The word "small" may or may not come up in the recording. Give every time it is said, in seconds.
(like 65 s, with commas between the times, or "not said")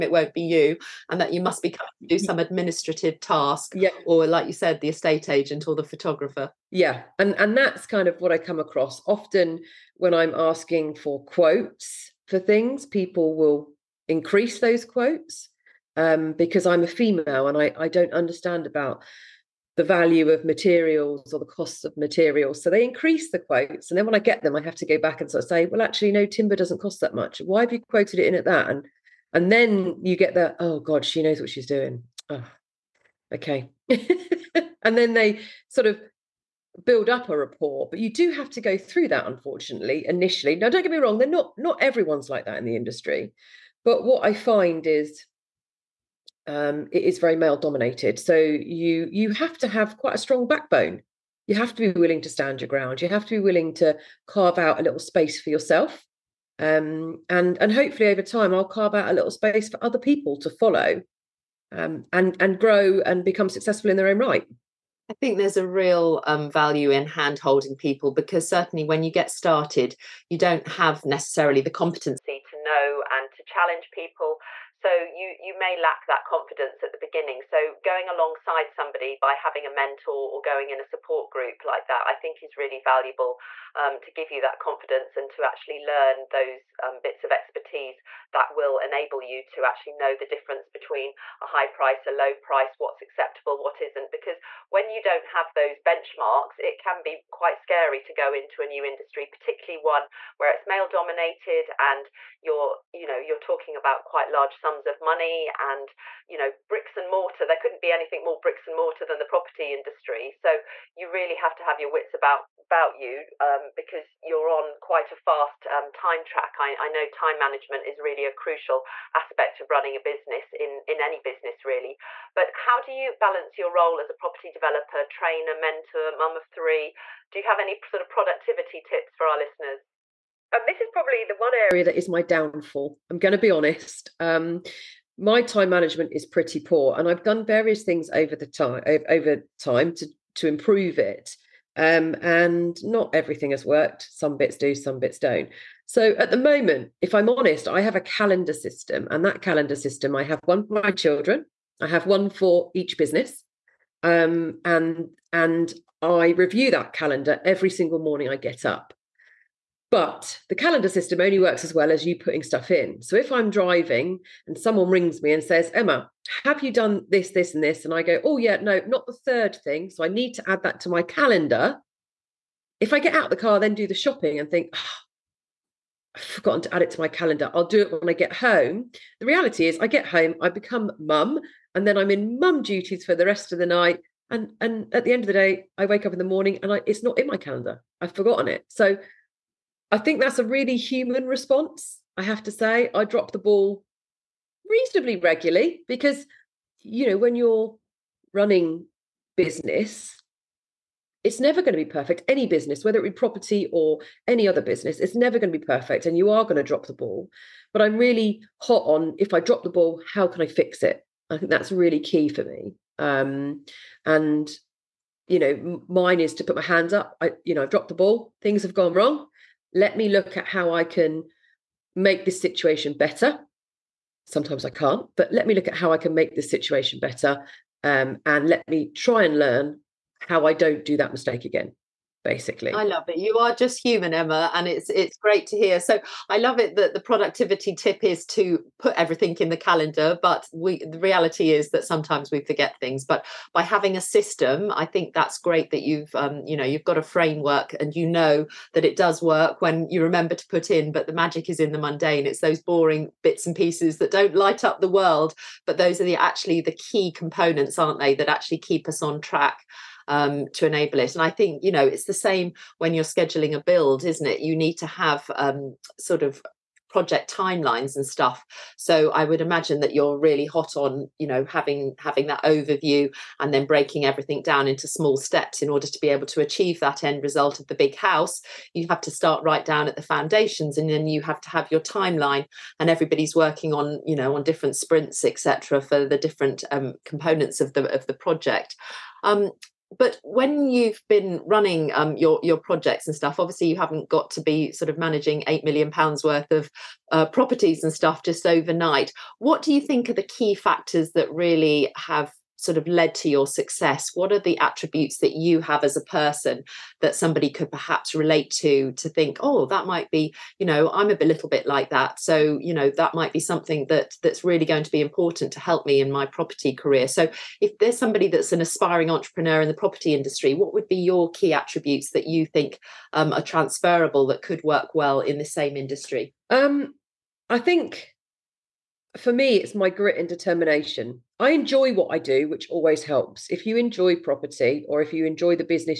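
274 s.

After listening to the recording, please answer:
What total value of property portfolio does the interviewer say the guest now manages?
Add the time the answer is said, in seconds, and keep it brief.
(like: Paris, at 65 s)
£8 million, at 295 s.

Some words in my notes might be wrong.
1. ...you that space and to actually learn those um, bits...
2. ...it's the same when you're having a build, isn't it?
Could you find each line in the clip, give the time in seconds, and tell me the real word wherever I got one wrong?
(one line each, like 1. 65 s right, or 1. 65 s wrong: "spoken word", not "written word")
1. 84 s wrong: "confidence", not "space"
2. 261 s wrong: "scheduling", not "having".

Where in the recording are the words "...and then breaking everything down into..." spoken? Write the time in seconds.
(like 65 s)
273 s.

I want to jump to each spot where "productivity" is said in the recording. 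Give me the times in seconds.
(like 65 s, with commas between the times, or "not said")
128 s, 236 s.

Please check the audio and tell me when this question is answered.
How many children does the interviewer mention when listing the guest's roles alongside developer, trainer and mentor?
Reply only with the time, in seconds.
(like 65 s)
126 s.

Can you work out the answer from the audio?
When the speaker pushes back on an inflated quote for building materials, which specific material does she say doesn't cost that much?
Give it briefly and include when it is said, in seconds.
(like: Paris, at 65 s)
timber, at 26 s.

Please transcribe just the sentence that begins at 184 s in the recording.
And and at the end of the day, I wake up in the morning and I, it's not in my calendar.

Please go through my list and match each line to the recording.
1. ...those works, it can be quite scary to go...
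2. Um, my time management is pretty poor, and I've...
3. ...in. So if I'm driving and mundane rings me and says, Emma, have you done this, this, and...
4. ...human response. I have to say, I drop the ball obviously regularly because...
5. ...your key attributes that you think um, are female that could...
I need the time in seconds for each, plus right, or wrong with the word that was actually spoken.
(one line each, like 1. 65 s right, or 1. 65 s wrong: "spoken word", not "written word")
1. 95 s wrong: "benchmarks", not "works"
2. 134 s right
3. 162 s wrong: "someone", not "mundane"
4. 190 s wrong: "reasonably", not "obviously"
5. 320 s wrong: "transferable", not "female".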